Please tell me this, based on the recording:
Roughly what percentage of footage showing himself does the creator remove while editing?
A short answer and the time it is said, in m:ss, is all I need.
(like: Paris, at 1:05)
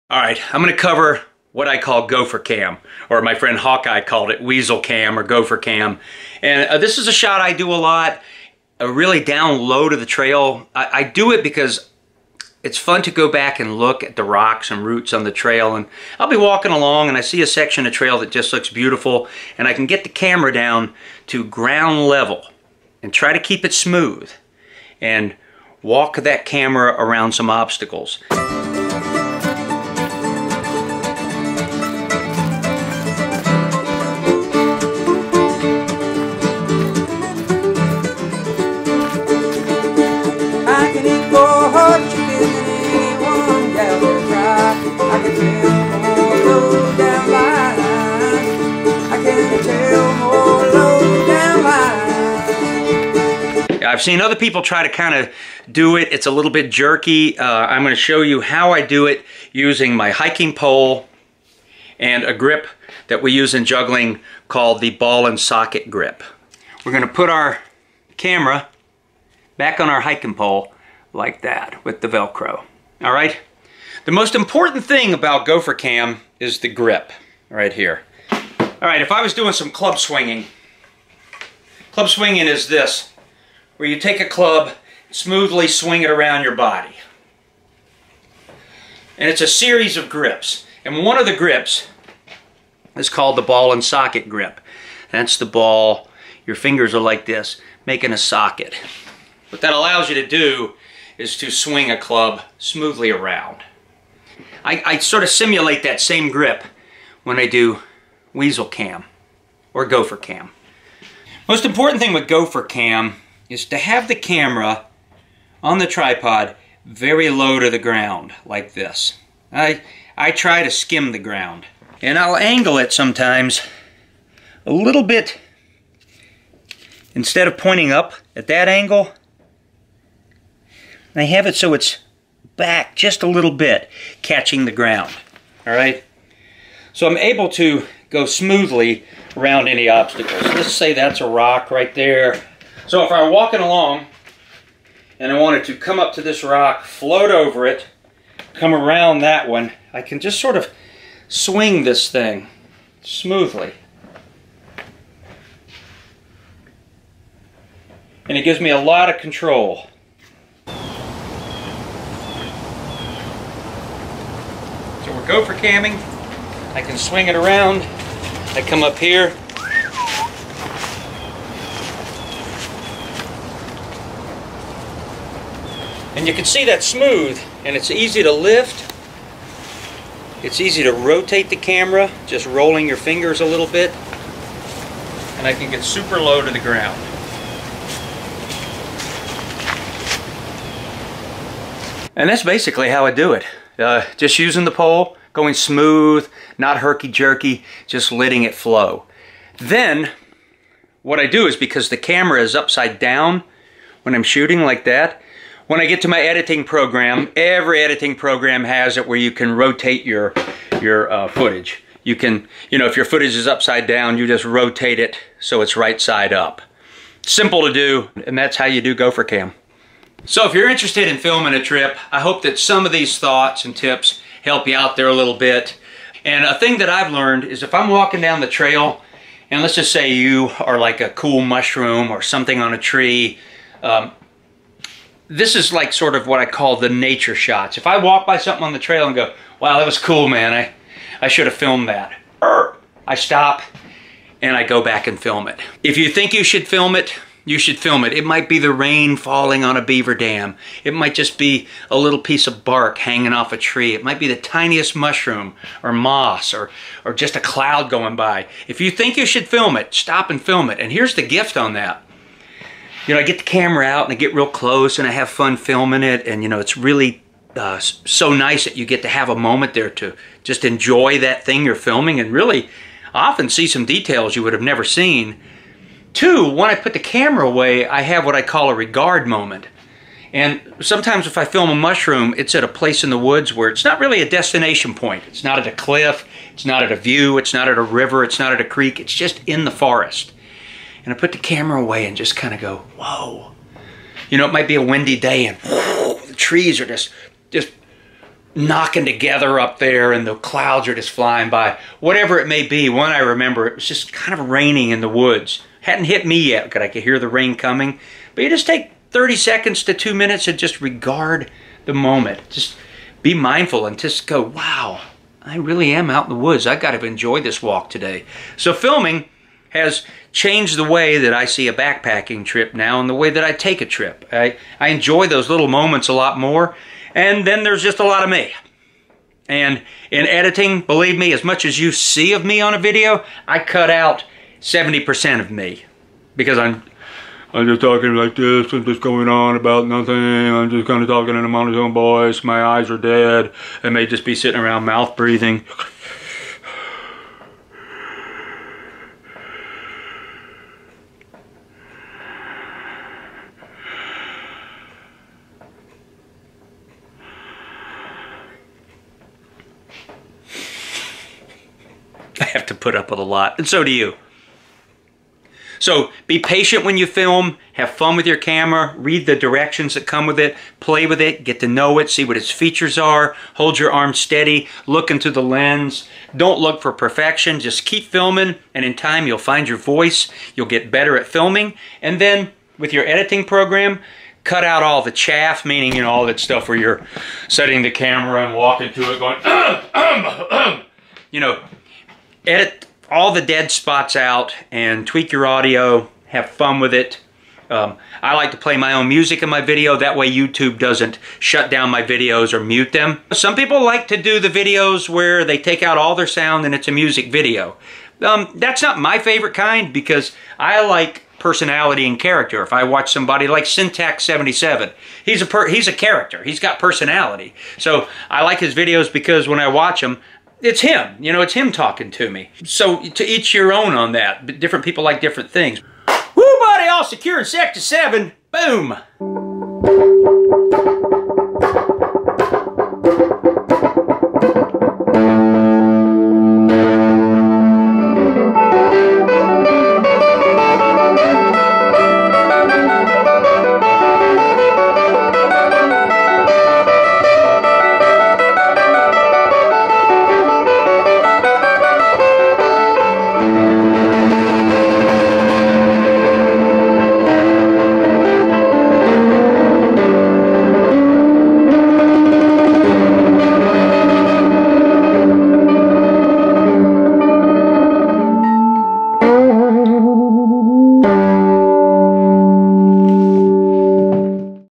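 70%, at 5:34.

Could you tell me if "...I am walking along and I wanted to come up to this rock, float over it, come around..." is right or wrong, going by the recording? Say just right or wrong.
right.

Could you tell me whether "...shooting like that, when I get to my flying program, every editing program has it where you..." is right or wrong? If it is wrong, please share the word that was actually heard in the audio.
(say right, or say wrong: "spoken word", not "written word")
wrong: "editing", not "flying".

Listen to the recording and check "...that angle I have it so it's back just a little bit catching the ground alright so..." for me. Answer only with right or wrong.
right.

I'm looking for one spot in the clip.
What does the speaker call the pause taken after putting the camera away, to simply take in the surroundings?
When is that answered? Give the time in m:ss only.
4:38.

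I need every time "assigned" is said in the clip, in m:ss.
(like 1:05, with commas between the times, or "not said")
not said.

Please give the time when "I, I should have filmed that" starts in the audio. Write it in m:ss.
4:00.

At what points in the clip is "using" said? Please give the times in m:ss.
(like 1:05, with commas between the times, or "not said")
0:59, 3:14.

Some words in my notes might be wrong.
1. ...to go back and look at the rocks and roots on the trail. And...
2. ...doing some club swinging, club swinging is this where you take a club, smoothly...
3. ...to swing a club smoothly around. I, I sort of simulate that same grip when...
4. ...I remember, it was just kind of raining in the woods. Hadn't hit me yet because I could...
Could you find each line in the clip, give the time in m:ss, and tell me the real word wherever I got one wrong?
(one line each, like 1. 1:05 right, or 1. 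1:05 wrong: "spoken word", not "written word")
1. 0:13 right
2. 1:19 right
3. 1:41 right
4. 5:03 right.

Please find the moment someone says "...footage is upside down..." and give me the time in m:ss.
3:33.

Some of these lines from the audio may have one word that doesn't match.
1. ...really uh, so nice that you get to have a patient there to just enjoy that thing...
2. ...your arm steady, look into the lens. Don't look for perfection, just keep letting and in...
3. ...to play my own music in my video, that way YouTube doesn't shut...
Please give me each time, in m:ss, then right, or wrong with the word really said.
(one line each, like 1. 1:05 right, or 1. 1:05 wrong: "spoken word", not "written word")
1. 4:26 wrong: "moment", not "patient"
2. 6:13 wrong: "filming", not "letting"
3. 6:38 right.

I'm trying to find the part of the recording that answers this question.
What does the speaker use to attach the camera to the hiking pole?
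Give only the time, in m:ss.
1:12.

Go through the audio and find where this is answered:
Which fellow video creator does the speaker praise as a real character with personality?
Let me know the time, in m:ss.
6:53.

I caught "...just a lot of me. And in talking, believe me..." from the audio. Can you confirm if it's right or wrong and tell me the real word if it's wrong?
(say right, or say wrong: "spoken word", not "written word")
wrong: "editing", not "talking".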